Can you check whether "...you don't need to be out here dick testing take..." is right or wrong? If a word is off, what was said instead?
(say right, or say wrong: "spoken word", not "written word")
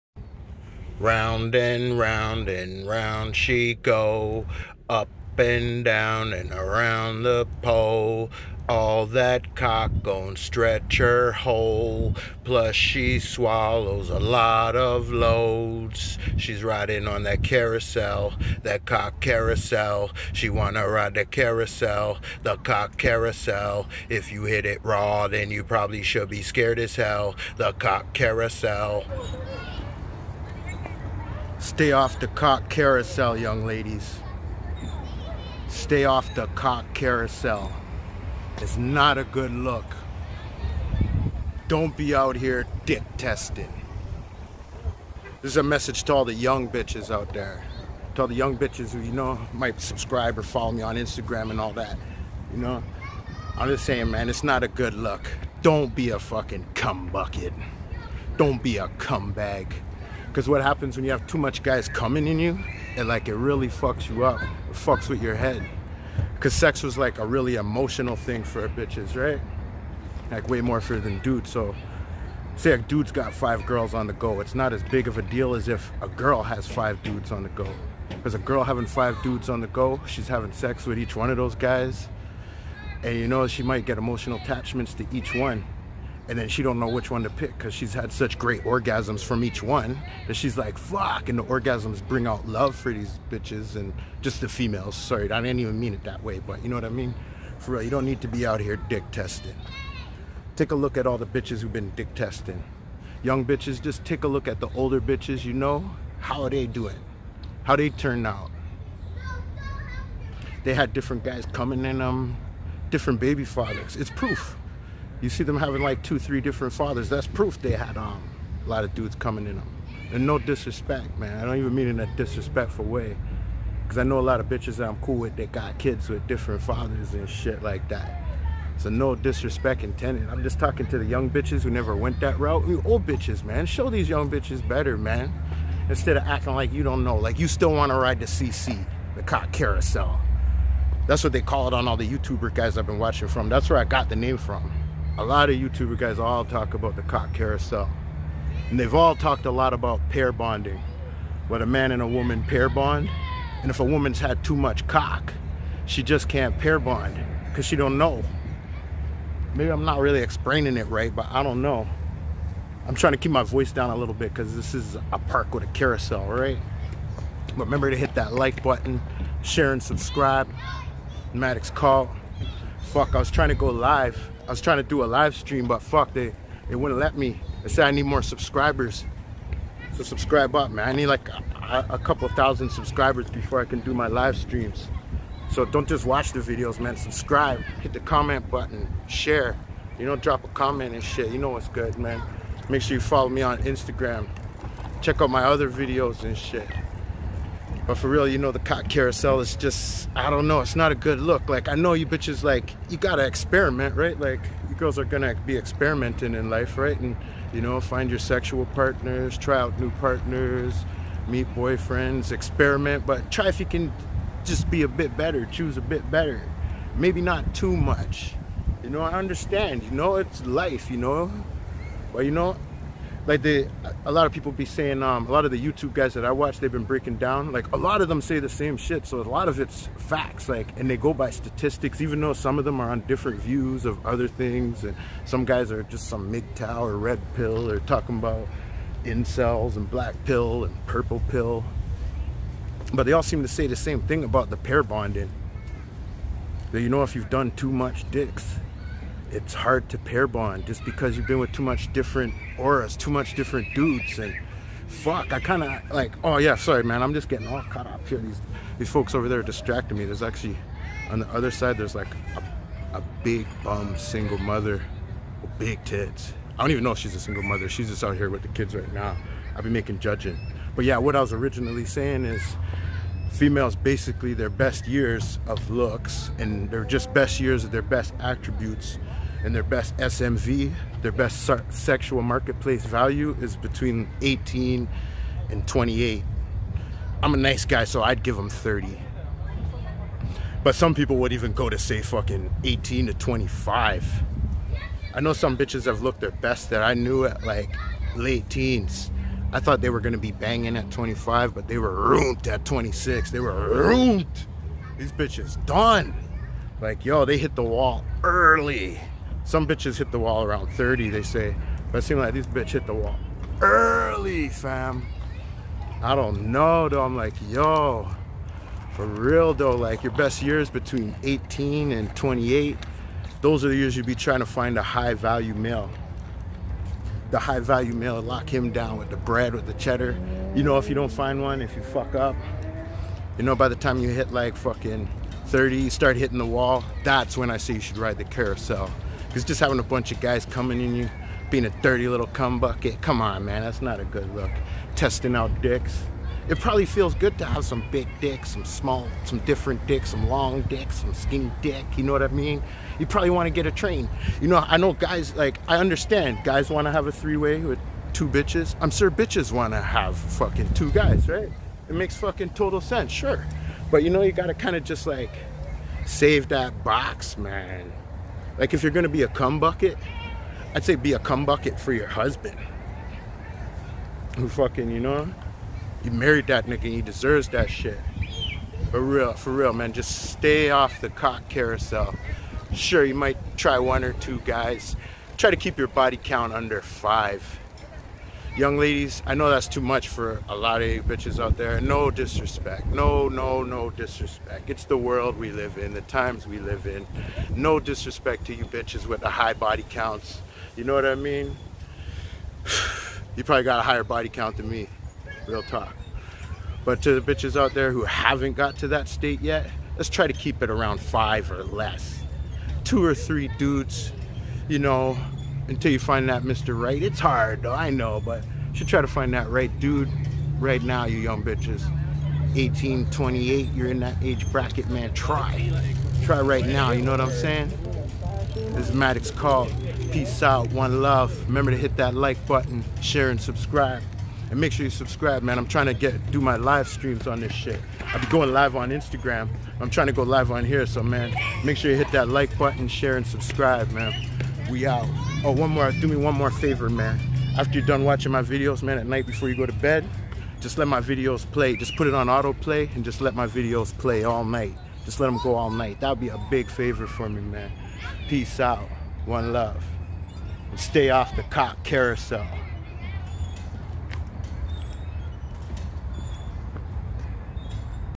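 right.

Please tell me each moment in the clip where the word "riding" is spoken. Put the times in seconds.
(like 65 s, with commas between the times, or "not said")
16 s.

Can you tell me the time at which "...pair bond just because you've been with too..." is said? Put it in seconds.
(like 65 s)
249 s.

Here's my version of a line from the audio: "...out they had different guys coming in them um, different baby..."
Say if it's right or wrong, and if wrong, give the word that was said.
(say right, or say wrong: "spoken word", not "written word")
right.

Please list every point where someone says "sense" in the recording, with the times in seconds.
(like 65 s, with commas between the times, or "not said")
362 s.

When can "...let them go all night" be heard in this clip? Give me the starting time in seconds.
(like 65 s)
455 s.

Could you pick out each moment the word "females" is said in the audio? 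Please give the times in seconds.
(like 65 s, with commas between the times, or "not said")
94 s, 273 s.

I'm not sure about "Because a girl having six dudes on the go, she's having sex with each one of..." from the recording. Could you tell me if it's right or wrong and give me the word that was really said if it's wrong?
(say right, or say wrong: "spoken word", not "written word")
wrong: "five", not "six".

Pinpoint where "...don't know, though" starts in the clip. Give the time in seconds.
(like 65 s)
316 s.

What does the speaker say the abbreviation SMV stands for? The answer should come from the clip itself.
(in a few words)
Sexual marketplace value.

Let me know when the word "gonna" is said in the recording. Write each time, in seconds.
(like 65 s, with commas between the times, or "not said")
205 s, 299 s, 368 s.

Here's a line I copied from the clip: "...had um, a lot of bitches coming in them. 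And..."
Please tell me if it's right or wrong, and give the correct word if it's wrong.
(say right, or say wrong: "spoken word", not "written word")
wrong: "dudes", not "bitches".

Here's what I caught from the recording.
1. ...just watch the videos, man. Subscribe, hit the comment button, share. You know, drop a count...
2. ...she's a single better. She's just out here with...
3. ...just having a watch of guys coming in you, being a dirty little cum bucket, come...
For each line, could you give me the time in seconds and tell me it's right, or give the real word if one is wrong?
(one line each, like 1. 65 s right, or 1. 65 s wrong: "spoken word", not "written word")
1. 185 s wrong: "comment", not "count"
2. 266 s wrong: "mother", not "better"
3. 339 s wrong: "bunch", not "watch".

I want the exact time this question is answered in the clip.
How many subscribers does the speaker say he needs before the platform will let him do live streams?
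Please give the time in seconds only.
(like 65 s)
181 s.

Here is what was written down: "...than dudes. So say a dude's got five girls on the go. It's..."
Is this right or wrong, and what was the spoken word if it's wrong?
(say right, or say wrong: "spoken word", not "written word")
right.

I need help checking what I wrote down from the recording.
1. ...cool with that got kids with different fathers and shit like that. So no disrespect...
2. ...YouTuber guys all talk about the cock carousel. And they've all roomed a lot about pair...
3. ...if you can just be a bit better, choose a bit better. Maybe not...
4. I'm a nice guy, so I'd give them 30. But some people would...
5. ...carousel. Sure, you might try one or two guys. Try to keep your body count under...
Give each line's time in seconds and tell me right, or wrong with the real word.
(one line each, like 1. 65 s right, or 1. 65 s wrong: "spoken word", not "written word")
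1. 125 s right
2. 145 s wrong: "talked", not "roomed"
3. 213 s right
4. 287 s right
5. 381 s right.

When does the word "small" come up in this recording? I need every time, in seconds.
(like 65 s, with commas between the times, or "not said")
348 s.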